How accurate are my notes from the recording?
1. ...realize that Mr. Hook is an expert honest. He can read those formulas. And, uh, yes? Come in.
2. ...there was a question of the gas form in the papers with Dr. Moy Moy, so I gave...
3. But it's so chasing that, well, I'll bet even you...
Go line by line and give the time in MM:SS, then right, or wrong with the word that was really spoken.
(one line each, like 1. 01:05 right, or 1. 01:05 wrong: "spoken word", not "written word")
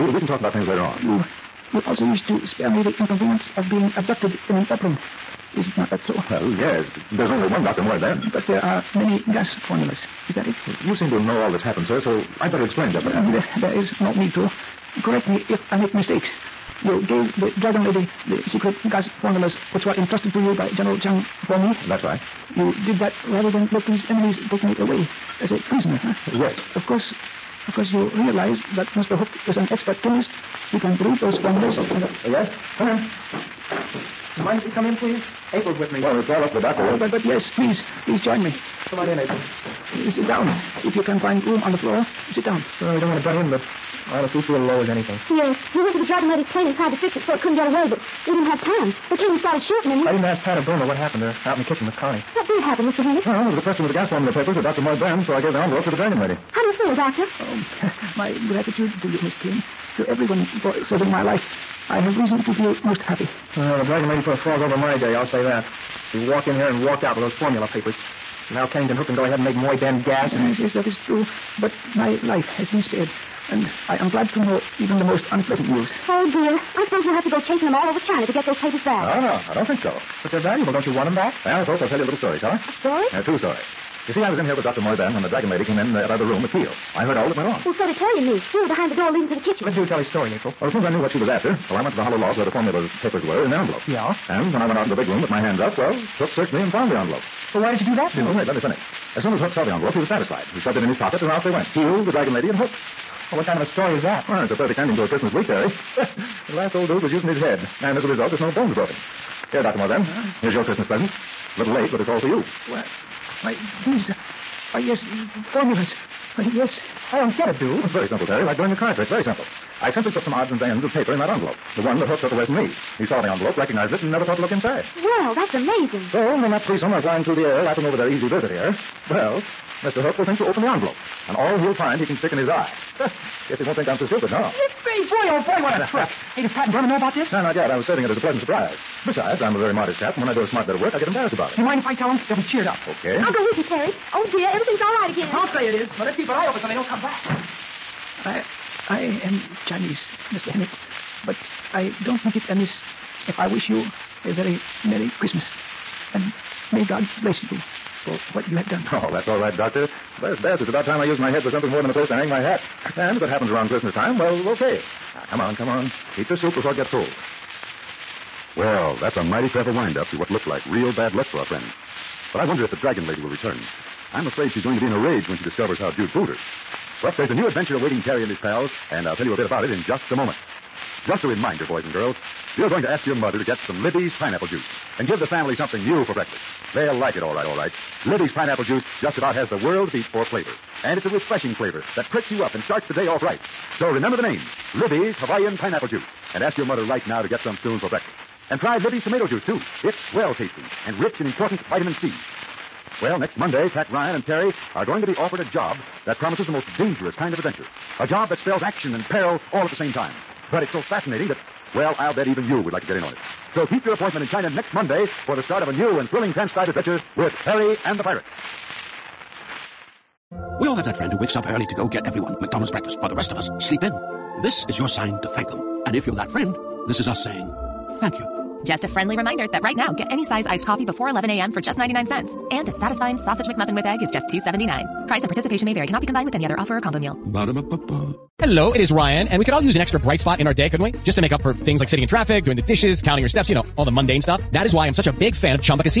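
1. 00:28 wrong: "chemist", not "honest"
2. 00:53 wrong: "Ben", not "Moy"
3. 03:30 wrong: "fascinating", not "chasing".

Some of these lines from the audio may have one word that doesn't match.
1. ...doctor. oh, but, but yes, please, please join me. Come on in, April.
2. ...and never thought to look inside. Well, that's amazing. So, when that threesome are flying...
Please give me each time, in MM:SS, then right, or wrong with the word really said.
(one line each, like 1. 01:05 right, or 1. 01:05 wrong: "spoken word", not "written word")
1. 00:36 right
2. 02:04 right.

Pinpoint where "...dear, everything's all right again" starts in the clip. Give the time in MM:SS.
02:24.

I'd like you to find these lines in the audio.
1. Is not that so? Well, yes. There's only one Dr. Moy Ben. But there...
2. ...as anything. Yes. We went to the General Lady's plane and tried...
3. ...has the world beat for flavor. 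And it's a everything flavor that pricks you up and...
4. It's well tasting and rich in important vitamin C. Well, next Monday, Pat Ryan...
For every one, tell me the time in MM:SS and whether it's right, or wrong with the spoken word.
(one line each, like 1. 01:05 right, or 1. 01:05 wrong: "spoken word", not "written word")
1. 00:05 right
2. 00:44 wrong: "Dragon", not "General"
3. 03:09 wrong: "refreshing", not "everything"
4. 03:19 right.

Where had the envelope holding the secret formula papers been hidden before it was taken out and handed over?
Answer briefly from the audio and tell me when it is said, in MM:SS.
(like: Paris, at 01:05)
Hollow log, at 01:32.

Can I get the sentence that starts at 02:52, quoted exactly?
But I wonder if the dragon lady will return.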